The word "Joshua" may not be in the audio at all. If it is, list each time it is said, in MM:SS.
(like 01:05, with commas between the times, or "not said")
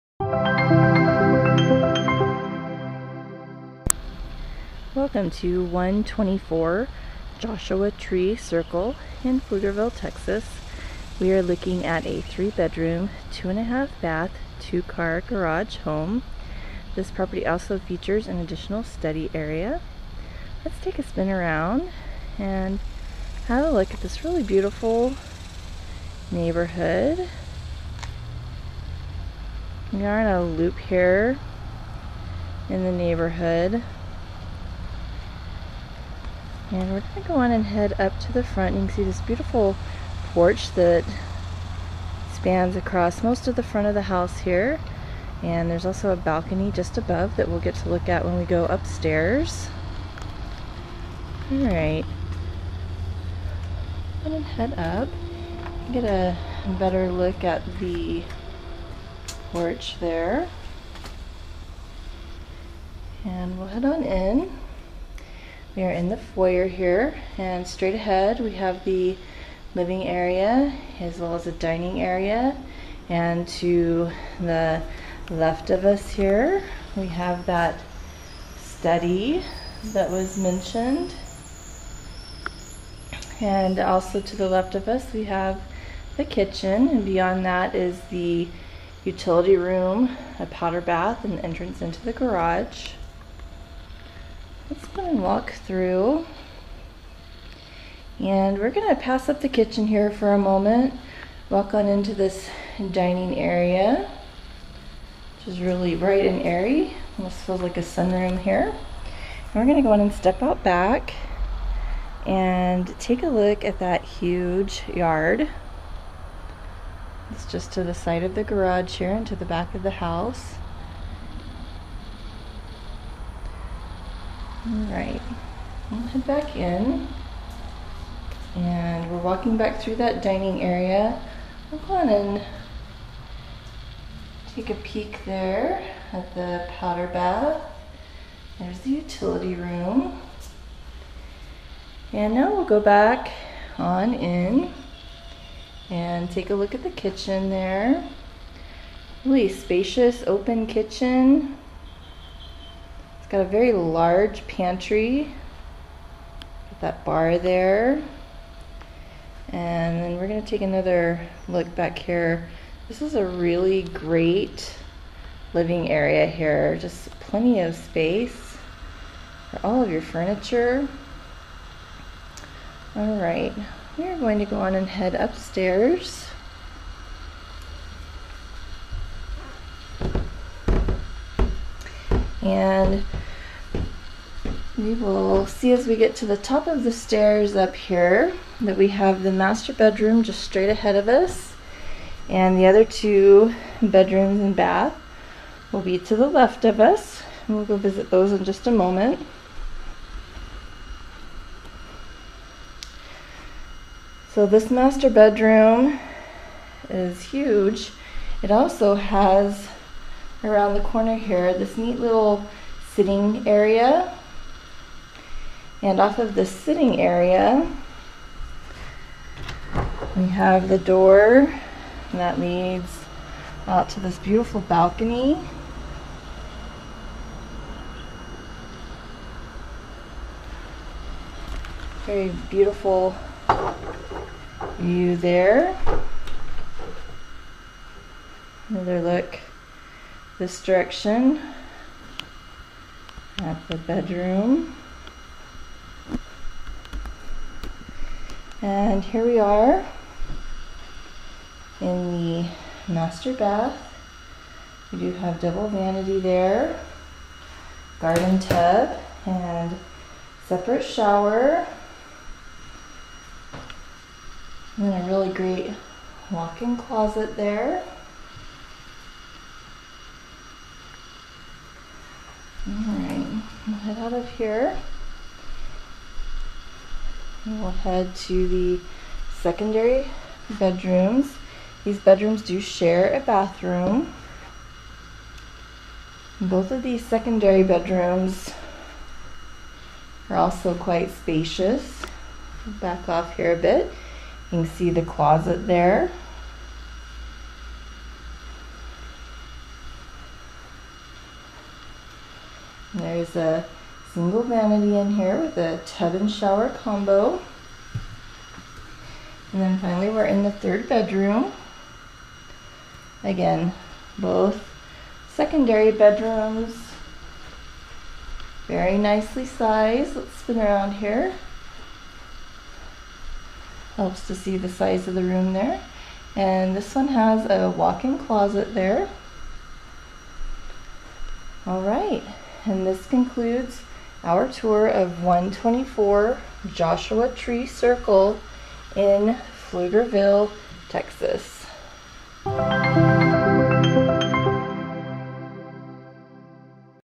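00:07, 05:36.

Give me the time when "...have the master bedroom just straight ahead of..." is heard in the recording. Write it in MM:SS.
03:08.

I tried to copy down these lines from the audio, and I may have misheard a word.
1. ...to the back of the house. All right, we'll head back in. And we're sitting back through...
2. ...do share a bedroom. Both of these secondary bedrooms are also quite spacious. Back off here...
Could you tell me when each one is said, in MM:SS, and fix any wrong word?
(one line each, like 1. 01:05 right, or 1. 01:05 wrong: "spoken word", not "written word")
1. 01:59 wrong: "walking", not "sitting"
2. 04:42 wrong: "bathroom", not "bedroom".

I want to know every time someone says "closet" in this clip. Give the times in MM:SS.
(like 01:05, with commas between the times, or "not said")
04:26, 04:55, 05:28.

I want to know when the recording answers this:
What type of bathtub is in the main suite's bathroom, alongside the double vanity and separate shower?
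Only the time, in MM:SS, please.
04:17.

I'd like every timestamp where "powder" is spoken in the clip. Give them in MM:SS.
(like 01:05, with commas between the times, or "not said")
01:30, 02:16.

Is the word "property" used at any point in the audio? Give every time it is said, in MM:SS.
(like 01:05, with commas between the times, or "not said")
00:17.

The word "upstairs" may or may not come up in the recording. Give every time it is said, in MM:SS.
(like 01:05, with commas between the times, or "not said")
00:48, 02:55.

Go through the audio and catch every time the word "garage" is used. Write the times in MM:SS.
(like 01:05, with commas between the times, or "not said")
00:15, 01:32, 01:58.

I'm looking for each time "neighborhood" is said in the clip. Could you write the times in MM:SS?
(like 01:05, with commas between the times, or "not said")
00:26, 00:32.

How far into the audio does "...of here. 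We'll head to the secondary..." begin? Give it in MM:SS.
04:34.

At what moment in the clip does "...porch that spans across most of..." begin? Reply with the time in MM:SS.
00:40.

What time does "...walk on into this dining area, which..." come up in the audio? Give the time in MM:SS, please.
01:41.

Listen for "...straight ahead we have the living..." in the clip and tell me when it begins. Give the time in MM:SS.
01:07.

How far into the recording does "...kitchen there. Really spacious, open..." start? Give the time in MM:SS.
02:26.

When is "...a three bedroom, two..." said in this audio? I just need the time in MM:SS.
00:12.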